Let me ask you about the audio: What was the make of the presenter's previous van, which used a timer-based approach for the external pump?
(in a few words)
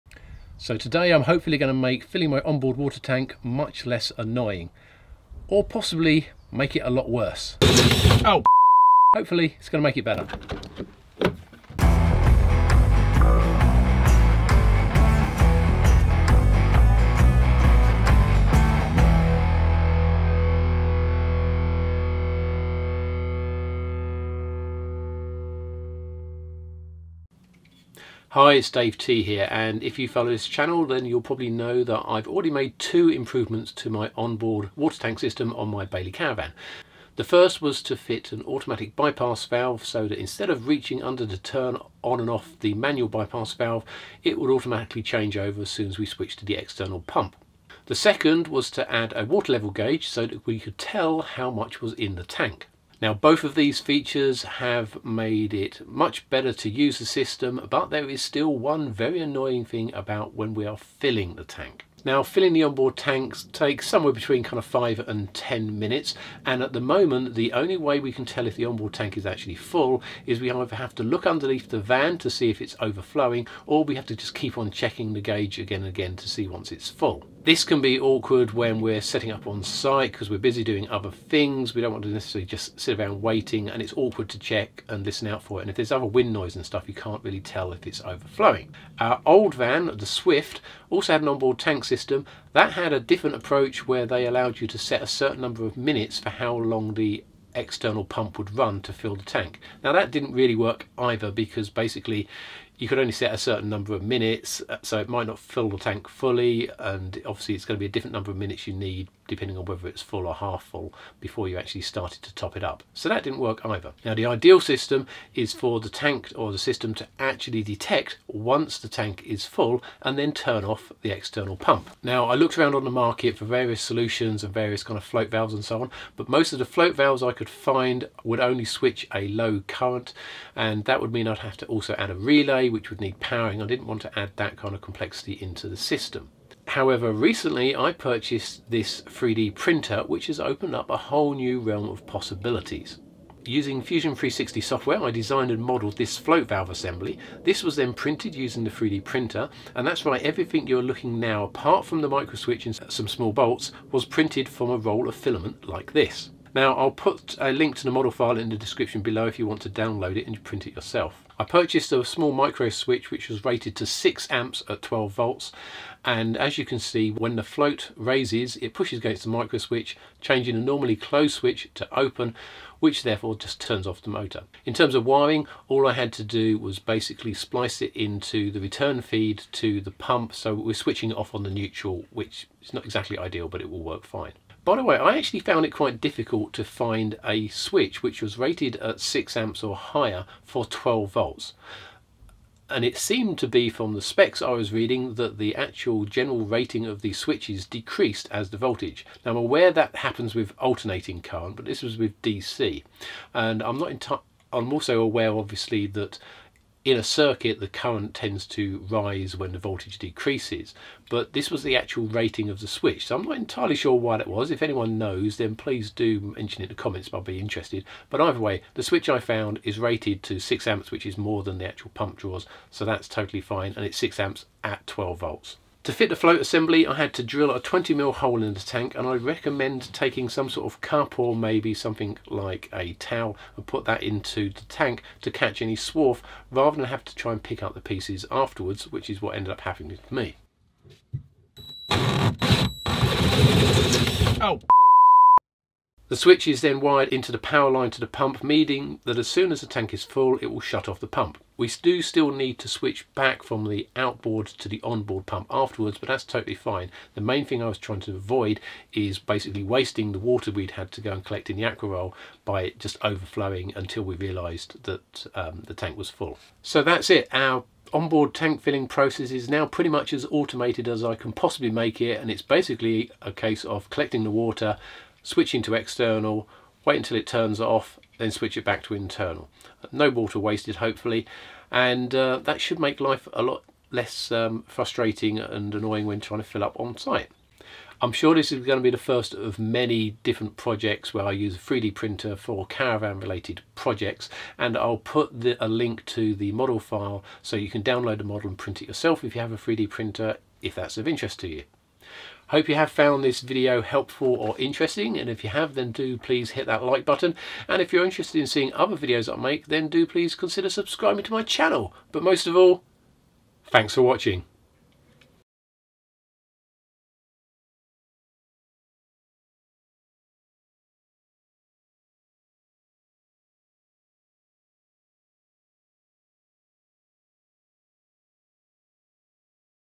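Swift.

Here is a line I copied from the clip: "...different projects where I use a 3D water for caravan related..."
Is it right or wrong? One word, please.
wrong.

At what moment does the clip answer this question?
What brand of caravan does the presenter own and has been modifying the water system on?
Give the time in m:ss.
0:35.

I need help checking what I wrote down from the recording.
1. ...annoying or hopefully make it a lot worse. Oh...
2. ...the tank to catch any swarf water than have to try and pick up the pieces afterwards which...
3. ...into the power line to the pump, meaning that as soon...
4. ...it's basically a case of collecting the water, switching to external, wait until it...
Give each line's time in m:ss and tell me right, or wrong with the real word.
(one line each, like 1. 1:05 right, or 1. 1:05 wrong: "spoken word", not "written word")
1. 0:04 wrong: "possibly", not "hopefully"
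2. 3:54 wrong: "rather", not "water"
3. 4:07 right
4. 4:32 right.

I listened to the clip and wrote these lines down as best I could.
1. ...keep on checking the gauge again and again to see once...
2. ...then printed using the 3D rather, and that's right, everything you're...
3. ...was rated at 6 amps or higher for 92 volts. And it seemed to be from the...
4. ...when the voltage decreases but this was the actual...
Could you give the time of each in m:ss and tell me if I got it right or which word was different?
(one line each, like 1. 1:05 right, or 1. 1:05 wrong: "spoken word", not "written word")
1. 1:14 right
2. 2:27 wrong: "printer", not "rather"
3. 3:08 wrong: "12", not "92"
4. 3:29 right.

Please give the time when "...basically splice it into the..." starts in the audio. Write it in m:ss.
2:56.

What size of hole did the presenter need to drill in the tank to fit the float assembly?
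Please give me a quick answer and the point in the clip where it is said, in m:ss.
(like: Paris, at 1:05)
20mm, at 3:47.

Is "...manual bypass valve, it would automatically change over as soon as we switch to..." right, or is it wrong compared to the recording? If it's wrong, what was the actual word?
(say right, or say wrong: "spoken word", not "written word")
right.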